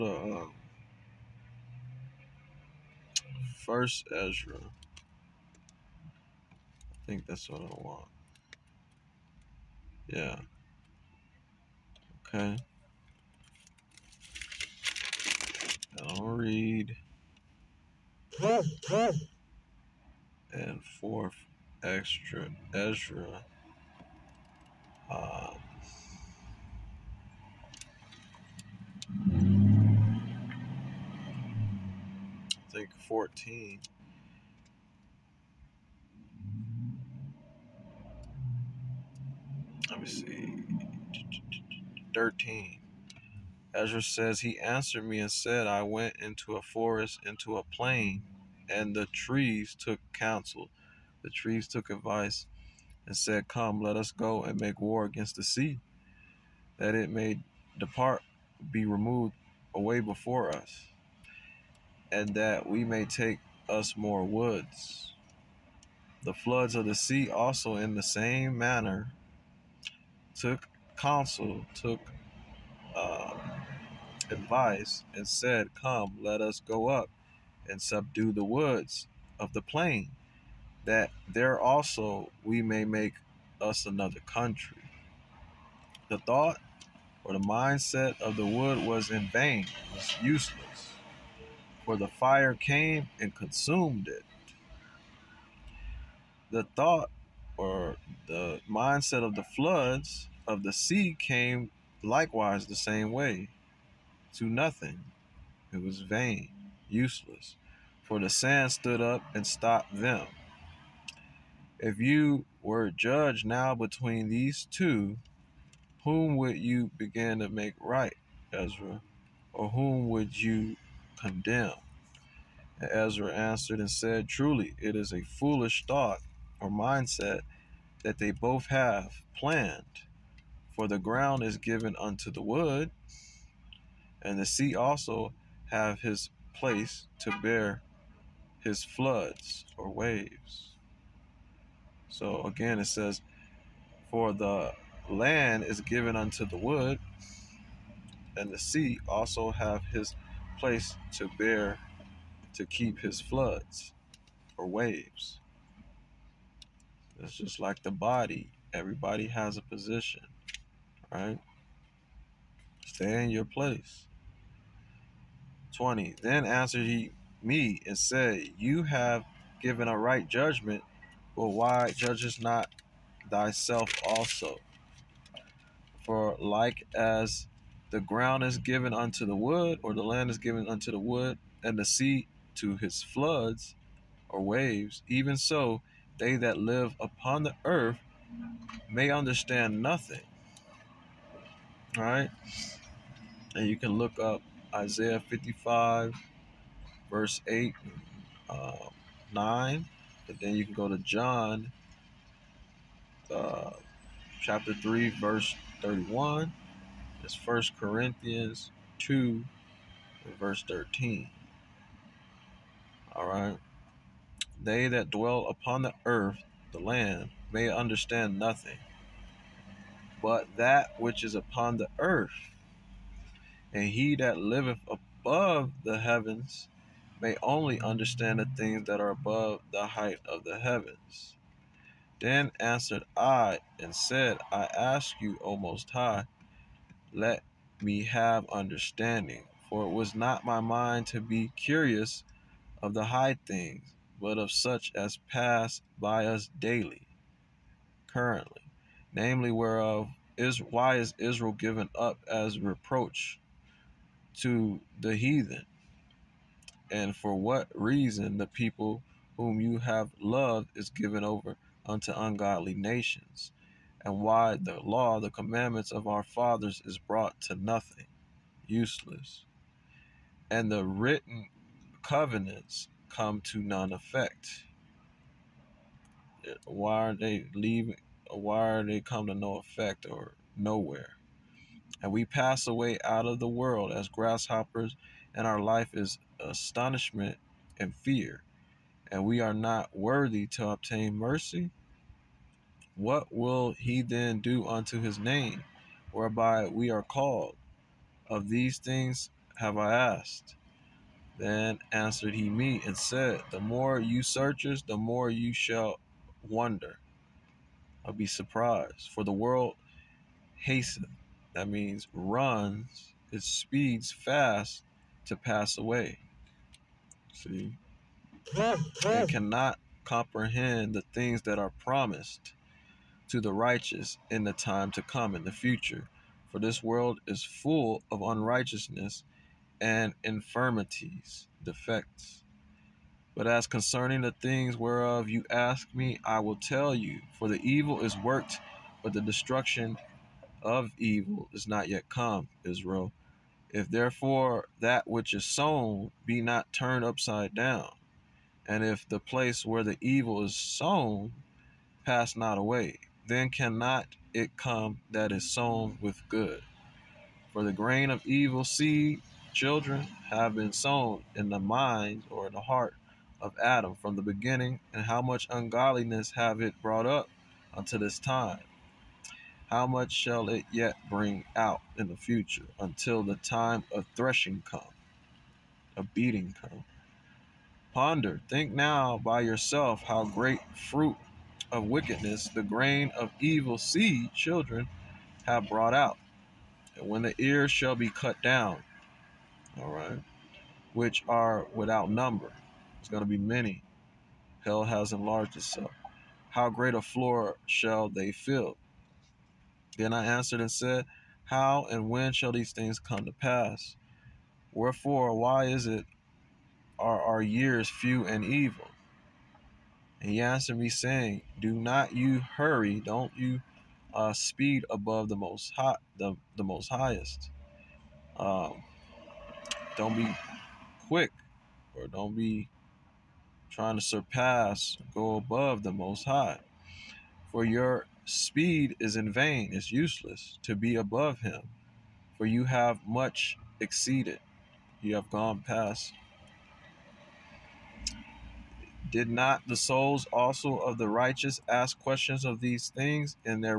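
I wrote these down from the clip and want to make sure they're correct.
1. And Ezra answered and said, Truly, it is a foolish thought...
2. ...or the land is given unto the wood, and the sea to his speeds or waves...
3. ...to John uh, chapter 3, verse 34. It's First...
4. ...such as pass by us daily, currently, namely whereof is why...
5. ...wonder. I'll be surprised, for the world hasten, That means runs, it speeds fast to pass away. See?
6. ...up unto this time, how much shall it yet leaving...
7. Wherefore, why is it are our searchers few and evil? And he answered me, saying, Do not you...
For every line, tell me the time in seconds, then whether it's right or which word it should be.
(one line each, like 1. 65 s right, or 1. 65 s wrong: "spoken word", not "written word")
1. 122 s right
2. 179 s wrong: "floods", not "speeds"
3. 200 s wrong: "31", not "34"
4. 244 s right
5. 306 s right
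6. 367 s wrong: "bring", not "leaving"
7. 404 s wrong: "years", not "searchers".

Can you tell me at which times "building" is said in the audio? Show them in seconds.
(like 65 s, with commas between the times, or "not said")
not said.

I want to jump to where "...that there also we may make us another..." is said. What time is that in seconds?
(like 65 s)
80 s.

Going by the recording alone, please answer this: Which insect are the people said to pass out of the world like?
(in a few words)
Grasshoppers.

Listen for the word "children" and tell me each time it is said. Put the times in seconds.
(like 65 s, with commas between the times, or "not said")
359 s, 384 s.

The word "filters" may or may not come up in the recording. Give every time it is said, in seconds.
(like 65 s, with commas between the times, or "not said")
not said.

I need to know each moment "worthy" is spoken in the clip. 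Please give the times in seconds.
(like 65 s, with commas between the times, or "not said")
289 s.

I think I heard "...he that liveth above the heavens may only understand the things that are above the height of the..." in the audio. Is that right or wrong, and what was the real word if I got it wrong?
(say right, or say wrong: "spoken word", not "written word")
right.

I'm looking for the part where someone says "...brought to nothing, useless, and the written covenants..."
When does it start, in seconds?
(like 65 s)
266 s.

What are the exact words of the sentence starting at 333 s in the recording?
But as concerning the things whereof you ask me, I will tell you.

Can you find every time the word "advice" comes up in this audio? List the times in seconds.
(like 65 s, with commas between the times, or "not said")
51 s, 74 s.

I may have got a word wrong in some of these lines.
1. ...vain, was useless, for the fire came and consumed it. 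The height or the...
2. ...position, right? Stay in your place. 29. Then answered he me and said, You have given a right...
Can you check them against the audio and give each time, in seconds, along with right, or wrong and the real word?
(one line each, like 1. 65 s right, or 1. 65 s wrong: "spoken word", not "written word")
1. 89 s wrong: "thought", not "height"
2. 159 s wrong: "20", not "29".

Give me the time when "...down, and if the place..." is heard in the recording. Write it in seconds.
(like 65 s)
347 s.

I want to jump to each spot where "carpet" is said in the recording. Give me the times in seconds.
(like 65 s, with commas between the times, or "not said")
not said.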